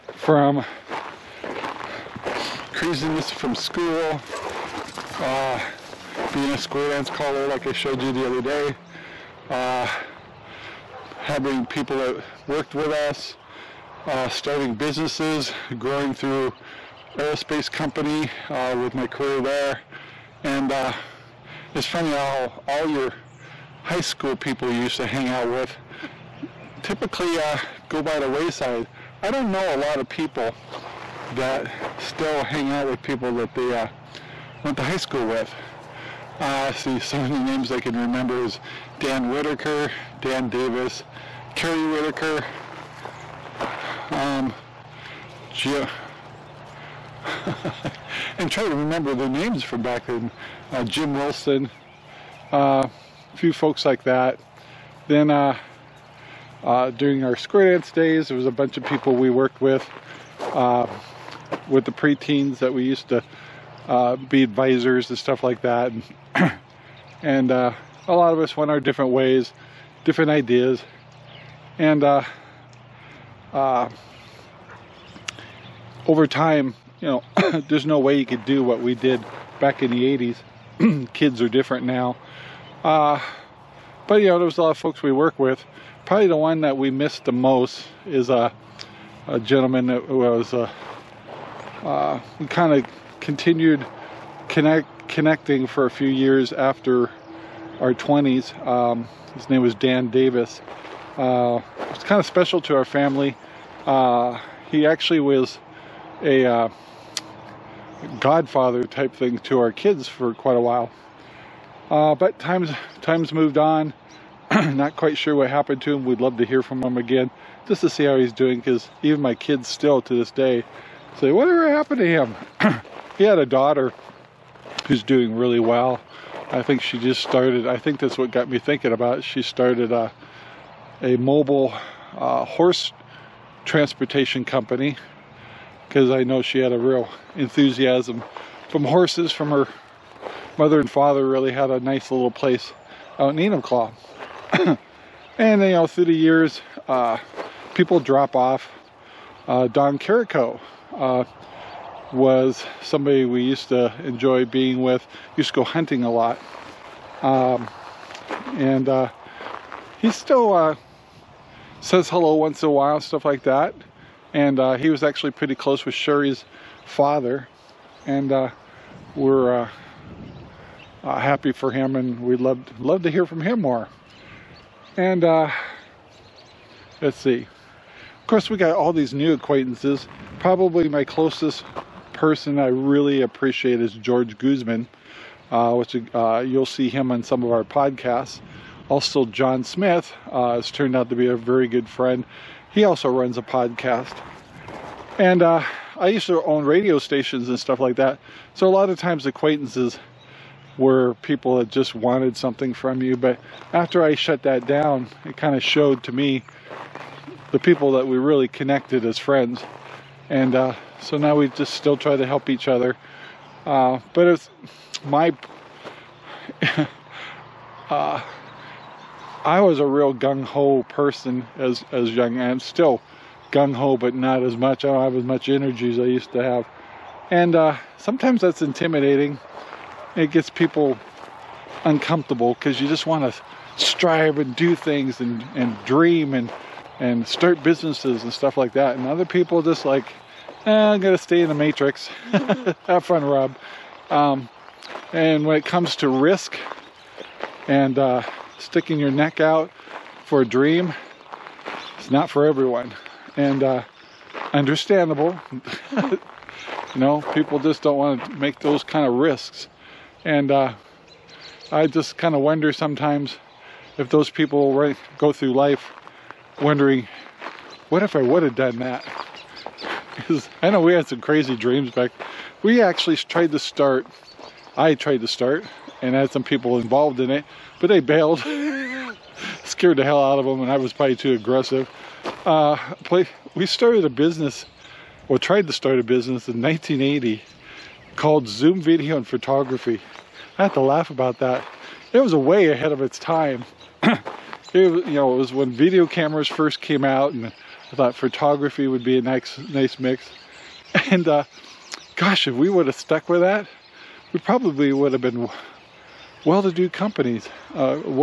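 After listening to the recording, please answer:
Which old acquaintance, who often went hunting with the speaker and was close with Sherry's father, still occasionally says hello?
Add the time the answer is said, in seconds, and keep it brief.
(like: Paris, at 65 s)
Don Carico, at 149 s.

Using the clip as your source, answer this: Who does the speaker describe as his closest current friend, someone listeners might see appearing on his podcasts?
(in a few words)
George Guzman.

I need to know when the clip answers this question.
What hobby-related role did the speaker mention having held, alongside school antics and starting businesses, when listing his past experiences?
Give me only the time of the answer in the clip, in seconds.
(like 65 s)
6 s.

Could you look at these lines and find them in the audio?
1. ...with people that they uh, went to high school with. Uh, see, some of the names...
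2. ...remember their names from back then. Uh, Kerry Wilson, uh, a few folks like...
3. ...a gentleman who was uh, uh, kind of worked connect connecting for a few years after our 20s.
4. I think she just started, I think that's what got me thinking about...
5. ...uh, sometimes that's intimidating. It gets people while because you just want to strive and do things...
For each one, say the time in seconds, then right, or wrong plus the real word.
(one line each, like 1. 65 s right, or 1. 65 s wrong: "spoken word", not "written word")
1. 32 s right
2. 48 s wrong: "Jim", not "Kerry"
3. 89 s wrong: "continued", not "worked"
4. 126 s right
5. 227 s wrong: "uncomfortable", not "while".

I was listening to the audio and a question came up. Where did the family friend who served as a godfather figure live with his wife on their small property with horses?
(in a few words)
Enumclaw.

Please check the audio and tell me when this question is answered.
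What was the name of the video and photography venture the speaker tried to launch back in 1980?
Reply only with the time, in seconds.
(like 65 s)
288 s.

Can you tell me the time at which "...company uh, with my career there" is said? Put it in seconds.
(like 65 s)
17 s.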